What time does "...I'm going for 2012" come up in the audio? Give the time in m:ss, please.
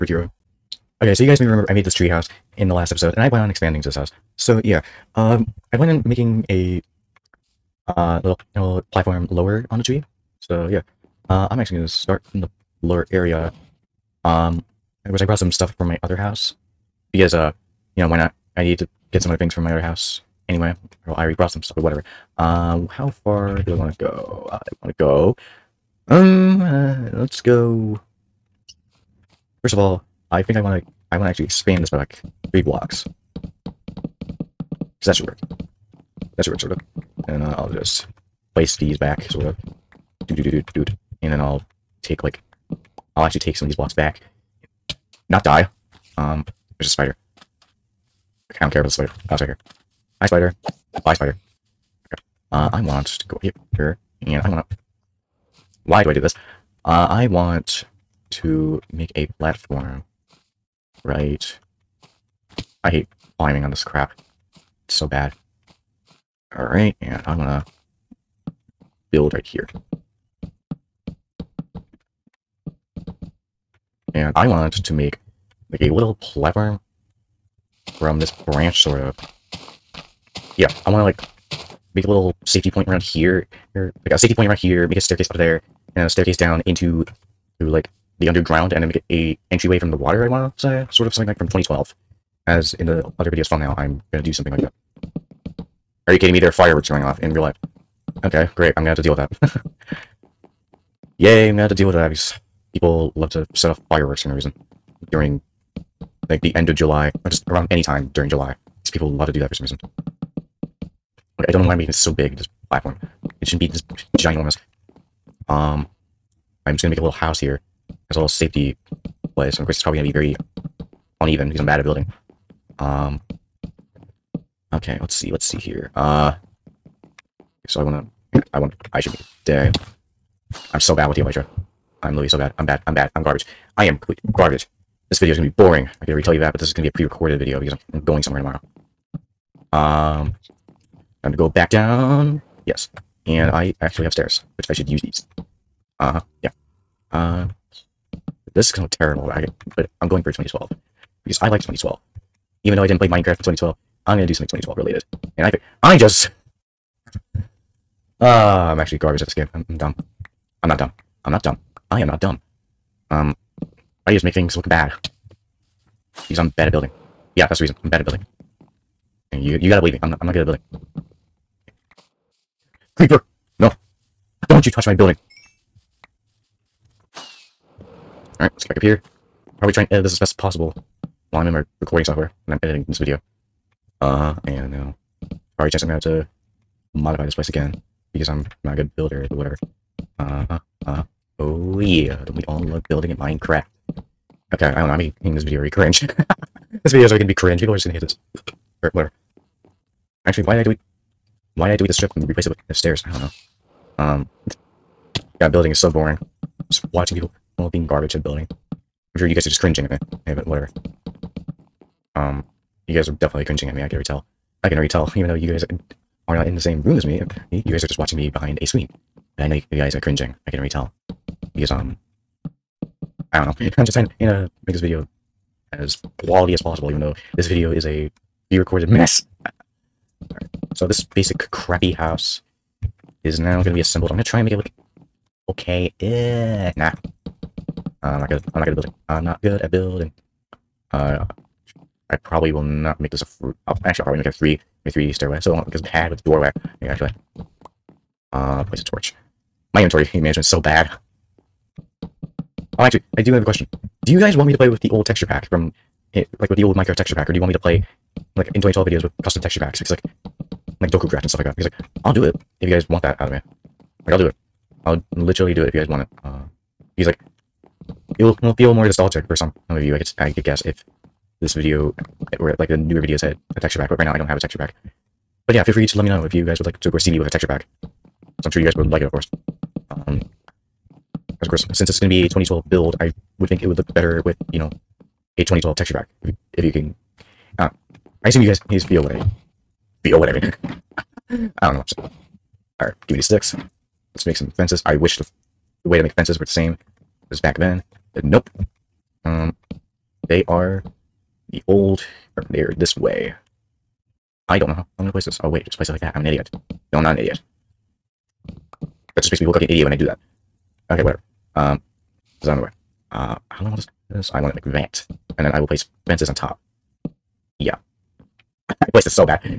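2:30.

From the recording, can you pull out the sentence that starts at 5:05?
Oh wait, just place it like that.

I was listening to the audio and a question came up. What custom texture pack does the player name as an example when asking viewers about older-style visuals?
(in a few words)
Dokucraft.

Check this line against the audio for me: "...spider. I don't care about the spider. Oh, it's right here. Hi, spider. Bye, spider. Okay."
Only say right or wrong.
right.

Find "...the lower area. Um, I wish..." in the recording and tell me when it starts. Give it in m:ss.
0:12.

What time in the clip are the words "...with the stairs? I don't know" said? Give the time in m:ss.
3:22.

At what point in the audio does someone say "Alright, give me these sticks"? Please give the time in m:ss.
4:52.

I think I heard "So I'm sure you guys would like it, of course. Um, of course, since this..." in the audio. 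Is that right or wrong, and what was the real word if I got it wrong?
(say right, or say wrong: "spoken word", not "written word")
right.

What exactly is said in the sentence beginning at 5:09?
That just makes me look like an idiot when I do that.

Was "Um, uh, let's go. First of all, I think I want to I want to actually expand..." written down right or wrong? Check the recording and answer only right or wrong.
right.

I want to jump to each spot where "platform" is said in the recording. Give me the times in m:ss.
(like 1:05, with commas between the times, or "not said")
0:08, 0:59, 1:16, 1:52.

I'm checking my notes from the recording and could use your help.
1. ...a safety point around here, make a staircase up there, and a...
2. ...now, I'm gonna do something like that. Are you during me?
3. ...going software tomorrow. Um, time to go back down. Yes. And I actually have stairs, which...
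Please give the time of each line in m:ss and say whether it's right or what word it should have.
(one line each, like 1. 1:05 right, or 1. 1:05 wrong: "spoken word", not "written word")
1. 1:24 right
2. 1:33 wrong: "kidding", not "during"
3. 2:18 wrong: "somewhere", not "software".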